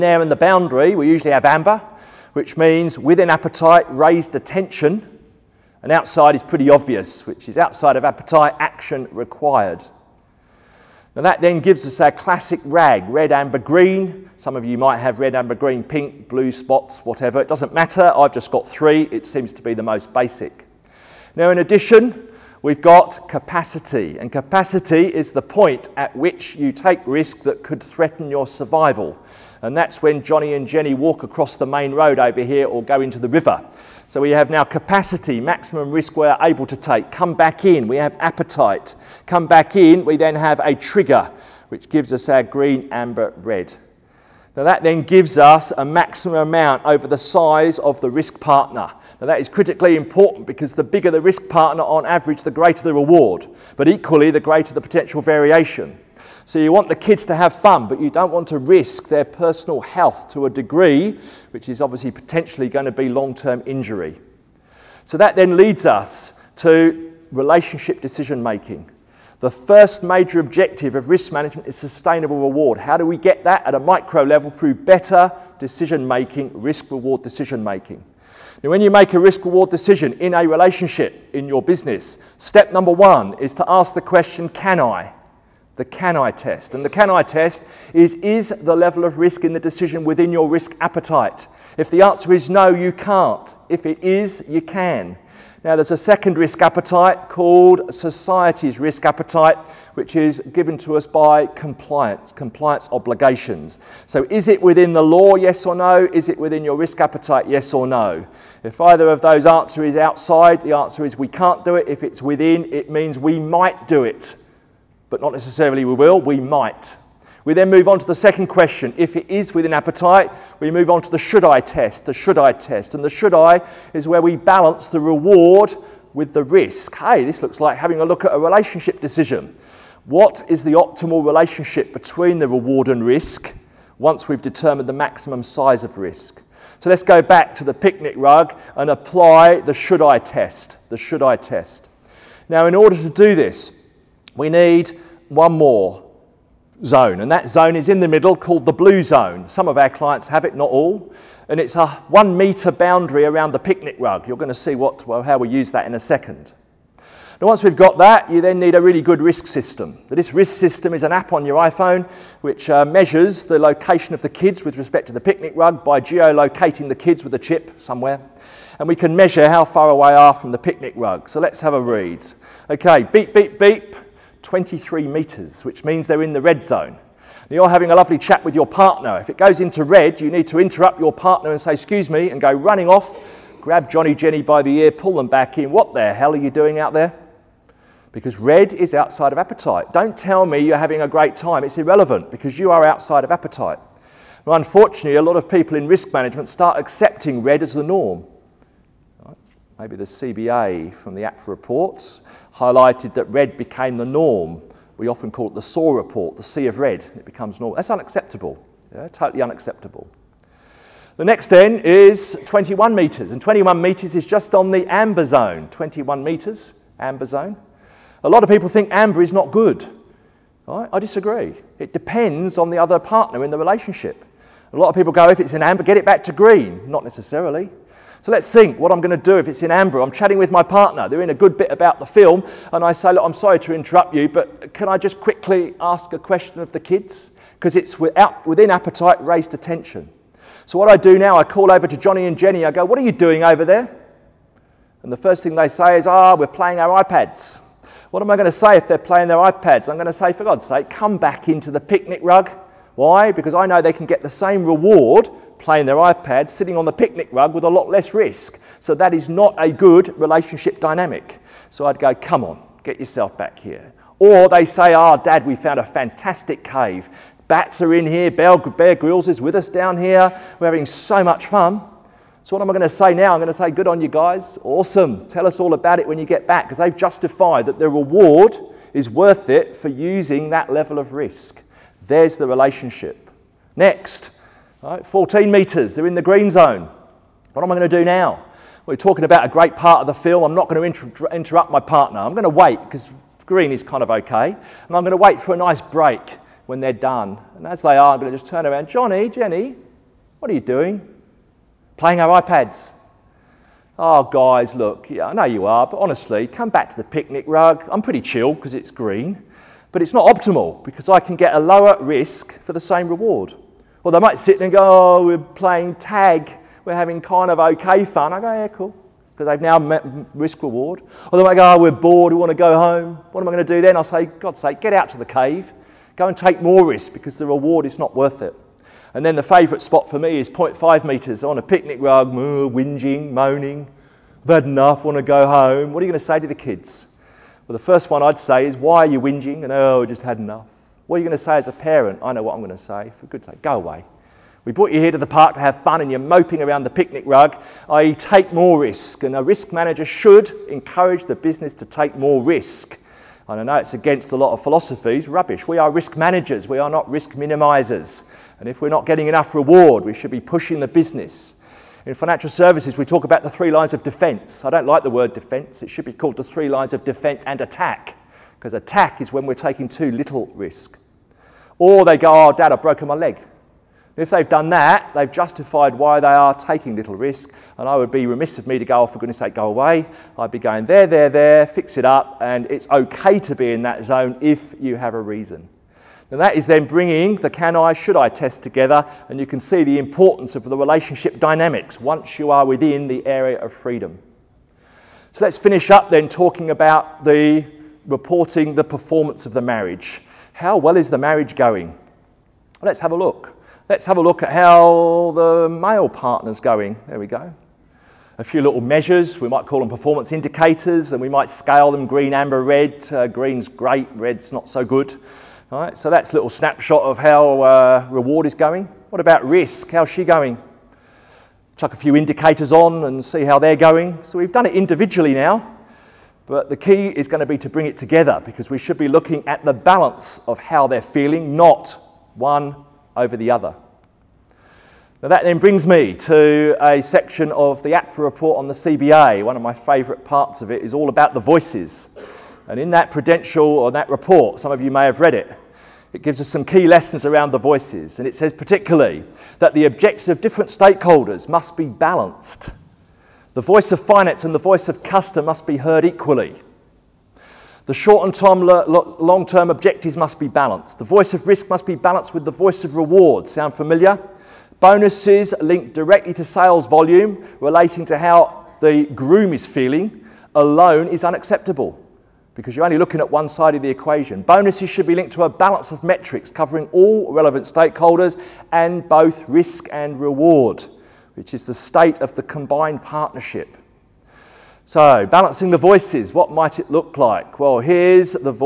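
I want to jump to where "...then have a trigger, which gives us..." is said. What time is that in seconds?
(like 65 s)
40 s.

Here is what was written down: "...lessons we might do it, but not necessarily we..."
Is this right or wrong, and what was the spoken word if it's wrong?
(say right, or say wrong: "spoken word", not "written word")
wrong: "means", not "lessons".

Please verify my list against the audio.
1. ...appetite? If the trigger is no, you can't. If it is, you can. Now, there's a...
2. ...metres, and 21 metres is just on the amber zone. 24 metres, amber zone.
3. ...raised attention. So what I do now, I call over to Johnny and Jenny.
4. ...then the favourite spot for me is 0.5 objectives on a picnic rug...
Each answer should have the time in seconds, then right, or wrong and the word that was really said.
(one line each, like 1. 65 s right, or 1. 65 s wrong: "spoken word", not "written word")
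1. 90 s wrong: "answer", not "trigger"
2. 212 s wrong: "21", not "24"
3. 239 s right
4. 329 s wrong: "metres", not "objectives".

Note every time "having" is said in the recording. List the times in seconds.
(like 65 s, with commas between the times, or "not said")
127 s, 177 s, 190 s, 270 s, 316 s.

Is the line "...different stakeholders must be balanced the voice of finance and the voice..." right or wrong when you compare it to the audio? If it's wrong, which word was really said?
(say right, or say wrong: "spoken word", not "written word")
right.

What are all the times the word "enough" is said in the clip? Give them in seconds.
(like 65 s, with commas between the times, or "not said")
334 s, 340 s, 359 s.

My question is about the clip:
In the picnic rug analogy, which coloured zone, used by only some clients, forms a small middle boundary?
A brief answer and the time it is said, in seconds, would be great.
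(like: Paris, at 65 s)
Blue zone, at 148 s.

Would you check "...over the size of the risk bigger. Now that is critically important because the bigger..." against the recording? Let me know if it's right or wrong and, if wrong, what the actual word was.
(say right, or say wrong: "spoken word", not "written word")
wrong: "partner", not "bigger".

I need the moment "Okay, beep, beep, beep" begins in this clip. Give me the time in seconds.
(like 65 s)
172 s.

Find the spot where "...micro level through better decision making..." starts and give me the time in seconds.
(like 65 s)
73 s.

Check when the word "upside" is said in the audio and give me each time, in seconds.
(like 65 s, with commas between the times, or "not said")
not said.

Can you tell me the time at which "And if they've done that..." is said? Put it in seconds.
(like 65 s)
373 s.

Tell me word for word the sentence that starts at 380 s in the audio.
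I'd be going there, there, there, fix it up.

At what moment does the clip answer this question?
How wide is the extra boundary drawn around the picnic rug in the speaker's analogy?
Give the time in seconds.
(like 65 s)
152 s.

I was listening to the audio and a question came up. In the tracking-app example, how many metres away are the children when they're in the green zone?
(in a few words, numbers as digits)
14.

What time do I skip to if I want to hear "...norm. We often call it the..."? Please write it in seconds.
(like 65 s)
204 s.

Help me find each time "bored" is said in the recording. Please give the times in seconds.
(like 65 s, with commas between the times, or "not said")
321 s.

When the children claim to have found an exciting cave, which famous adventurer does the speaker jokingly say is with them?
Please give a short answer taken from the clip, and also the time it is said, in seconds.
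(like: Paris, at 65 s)
Bear Grylls, at 268 s.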